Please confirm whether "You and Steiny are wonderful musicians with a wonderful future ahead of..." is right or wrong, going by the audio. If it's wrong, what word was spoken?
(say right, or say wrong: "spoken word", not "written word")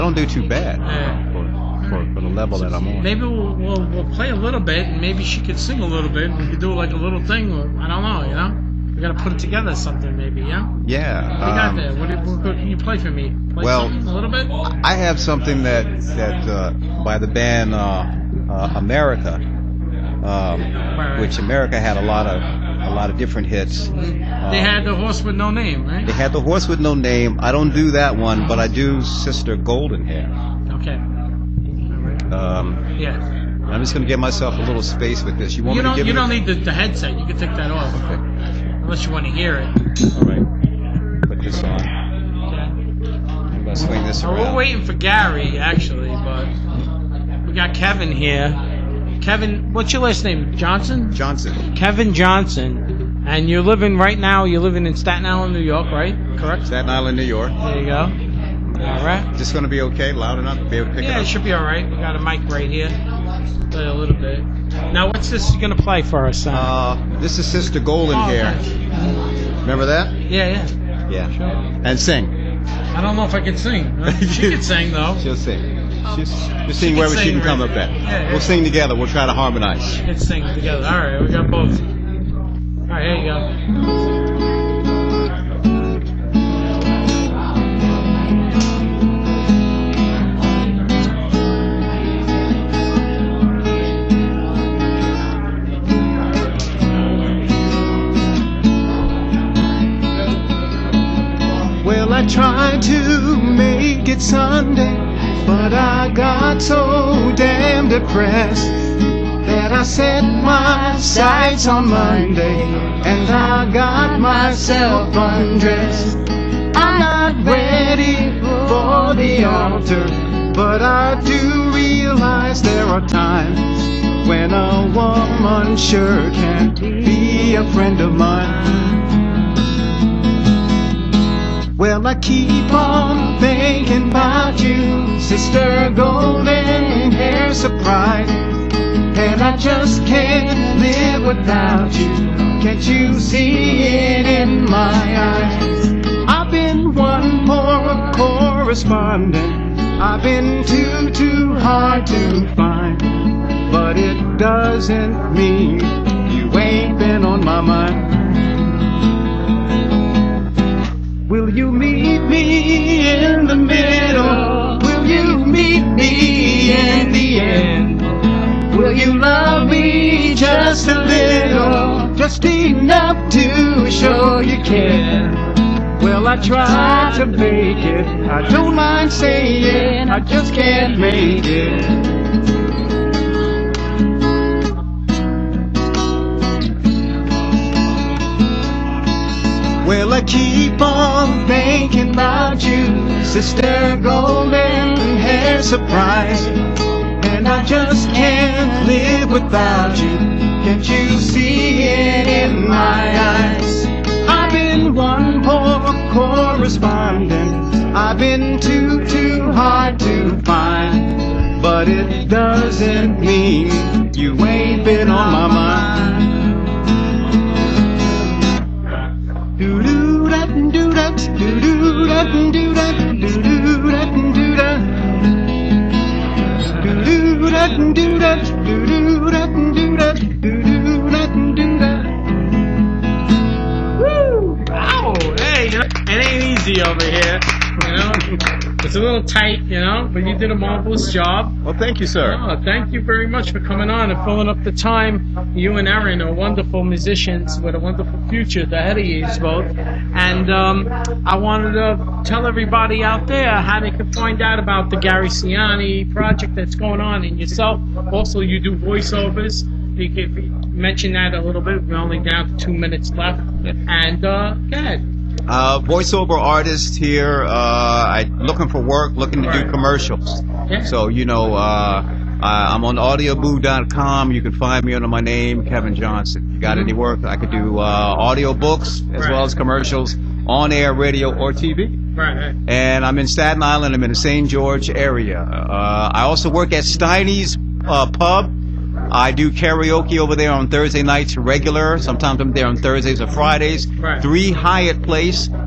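wrong: "Erin", not "Steiny".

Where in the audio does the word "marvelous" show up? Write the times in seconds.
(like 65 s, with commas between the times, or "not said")
240 s.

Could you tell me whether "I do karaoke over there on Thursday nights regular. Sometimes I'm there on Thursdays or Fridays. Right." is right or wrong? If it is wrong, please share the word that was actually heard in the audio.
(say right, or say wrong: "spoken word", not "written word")
right.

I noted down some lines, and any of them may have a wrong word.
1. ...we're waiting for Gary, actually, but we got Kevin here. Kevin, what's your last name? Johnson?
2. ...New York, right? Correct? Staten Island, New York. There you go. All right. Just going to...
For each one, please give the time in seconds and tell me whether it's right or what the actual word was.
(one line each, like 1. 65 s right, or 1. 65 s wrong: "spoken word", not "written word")
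1. 44 s right
2. 55 s right.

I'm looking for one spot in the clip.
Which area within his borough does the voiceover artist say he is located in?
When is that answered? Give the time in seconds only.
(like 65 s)
284 s.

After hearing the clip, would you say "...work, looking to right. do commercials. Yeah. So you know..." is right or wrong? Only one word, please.
right.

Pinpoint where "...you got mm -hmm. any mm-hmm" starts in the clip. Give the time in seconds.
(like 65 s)
276 s.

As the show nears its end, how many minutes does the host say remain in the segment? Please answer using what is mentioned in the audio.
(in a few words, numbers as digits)
2.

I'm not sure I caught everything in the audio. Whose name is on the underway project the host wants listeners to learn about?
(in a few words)
Gary Ciani.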